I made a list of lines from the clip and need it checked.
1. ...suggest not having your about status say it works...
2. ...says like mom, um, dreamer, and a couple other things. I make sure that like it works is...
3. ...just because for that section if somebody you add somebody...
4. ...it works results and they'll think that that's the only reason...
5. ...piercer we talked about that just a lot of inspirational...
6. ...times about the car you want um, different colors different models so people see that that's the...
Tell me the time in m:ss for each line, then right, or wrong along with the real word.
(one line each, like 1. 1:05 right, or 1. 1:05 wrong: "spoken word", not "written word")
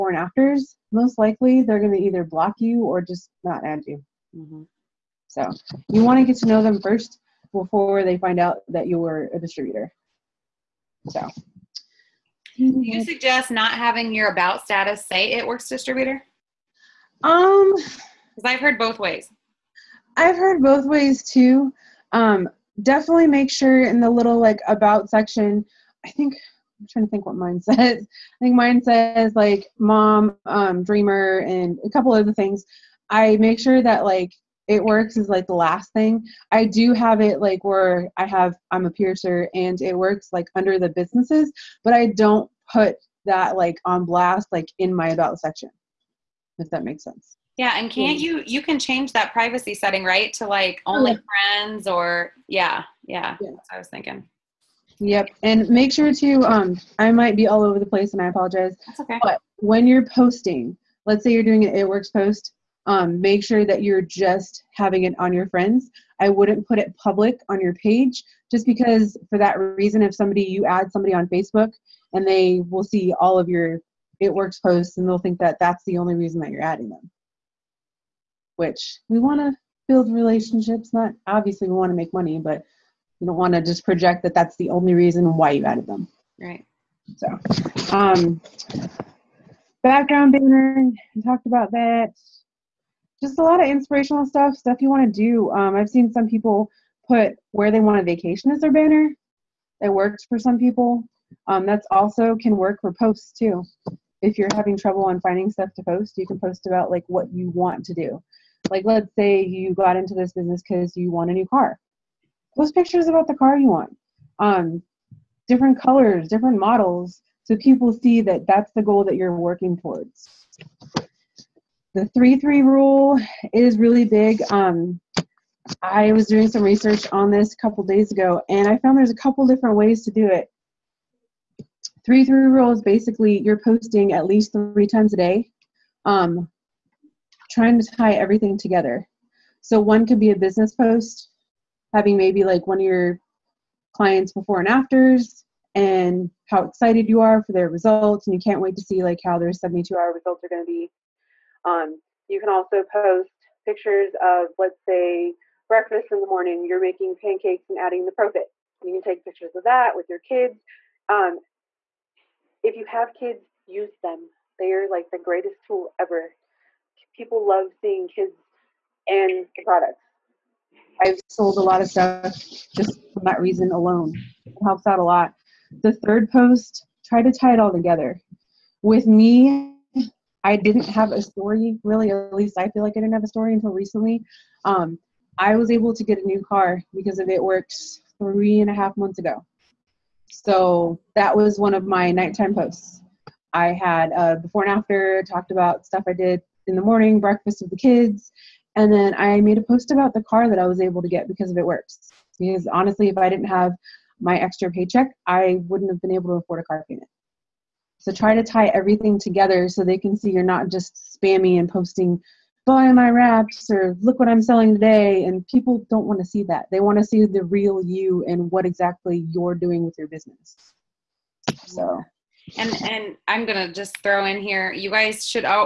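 1. 0:13 right
2. 0:28 right
3. 1:08 wrong: "reason", not "section"
4. 1:14 wrong: "posts", not "results"
5. 1:30 wrong: "banner", not "piercer"
6. 1:52 wrong: "pictures", not "times".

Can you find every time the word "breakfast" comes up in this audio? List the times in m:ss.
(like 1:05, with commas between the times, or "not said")
2:35, 3:17.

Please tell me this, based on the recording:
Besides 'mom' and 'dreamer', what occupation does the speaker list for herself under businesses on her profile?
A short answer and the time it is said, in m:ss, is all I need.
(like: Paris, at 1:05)
piercer, at 0:38.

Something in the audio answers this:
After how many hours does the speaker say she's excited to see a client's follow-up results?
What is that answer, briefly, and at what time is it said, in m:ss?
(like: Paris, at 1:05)
72, at 2:29.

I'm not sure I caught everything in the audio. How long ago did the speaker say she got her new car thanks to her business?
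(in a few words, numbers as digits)
three and a half months.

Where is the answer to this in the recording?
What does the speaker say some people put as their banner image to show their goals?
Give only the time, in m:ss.
1:37.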